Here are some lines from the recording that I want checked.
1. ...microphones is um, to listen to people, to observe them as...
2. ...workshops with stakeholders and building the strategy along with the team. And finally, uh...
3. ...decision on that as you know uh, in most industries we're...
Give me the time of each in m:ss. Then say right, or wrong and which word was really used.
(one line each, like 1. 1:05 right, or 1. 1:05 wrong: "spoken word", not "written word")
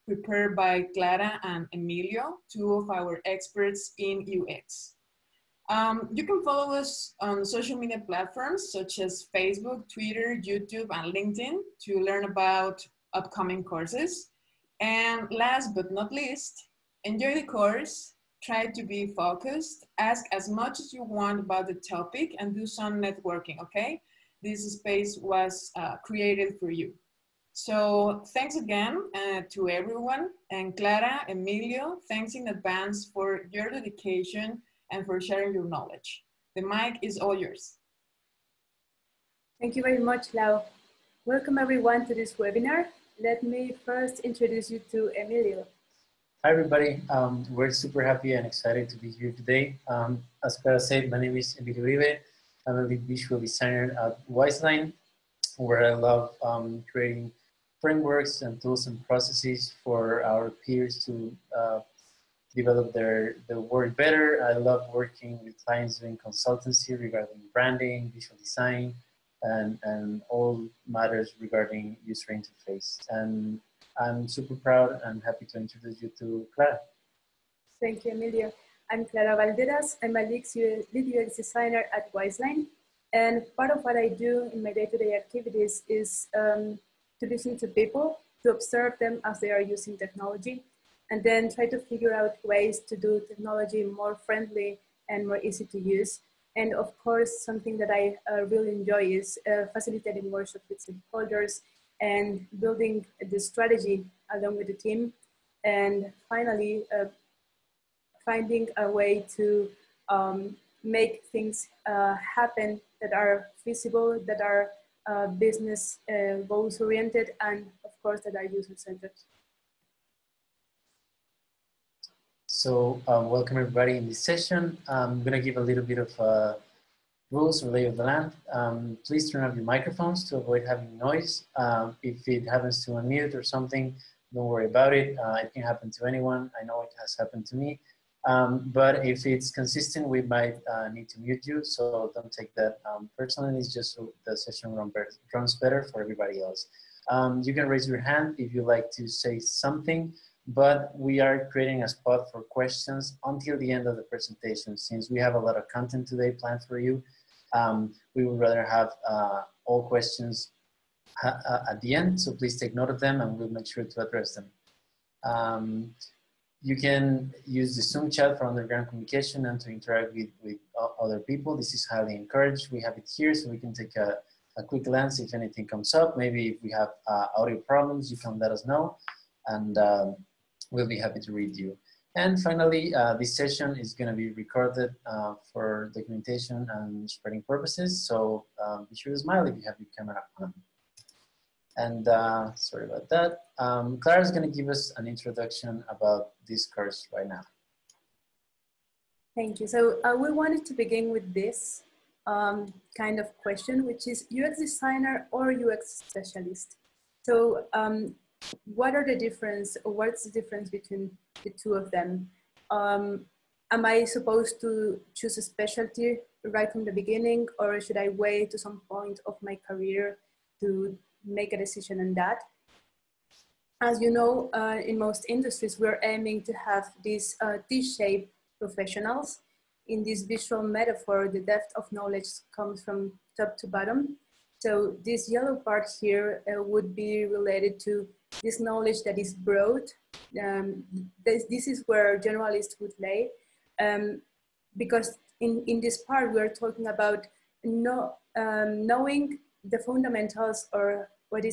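1. 1:25 wrong: "activities", not "microphones"
2. 1:40 right
3. 3:41 right.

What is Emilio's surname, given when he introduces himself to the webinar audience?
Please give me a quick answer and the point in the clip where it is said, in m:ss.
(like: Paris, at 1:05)
Uribe, at 0:51.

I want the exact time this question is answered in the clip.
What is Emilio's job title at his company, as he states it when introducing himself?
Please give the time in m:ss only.
0:52.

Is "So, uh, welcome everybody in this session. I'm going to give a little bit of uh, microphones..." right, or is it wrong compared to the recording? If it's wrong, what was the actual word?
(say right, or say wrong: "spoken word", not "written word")
wrong: "rules", not "microphones".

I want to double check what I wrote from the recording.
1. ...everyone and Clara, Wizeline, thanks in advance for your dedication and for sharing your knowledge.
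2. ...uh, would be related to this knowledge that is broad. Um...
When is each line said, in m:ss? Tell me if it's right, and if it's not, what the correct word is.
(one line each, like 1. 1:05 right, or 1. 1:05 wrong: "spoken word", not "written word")
1. 0:29 wrong: "Emilio", not "Wizeline"
2. 3:56 right.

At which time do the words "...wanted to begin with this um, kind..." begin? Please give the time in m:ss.
3:20.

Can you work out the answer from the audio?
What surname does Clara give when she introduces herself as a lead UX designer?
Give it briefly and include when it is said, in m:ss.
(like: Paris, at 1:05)
Valderas, at 1:19.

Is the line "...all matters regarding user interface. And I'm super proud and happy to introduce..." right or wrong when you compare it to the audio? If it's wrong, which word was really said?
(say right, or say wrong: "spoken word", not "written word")
right.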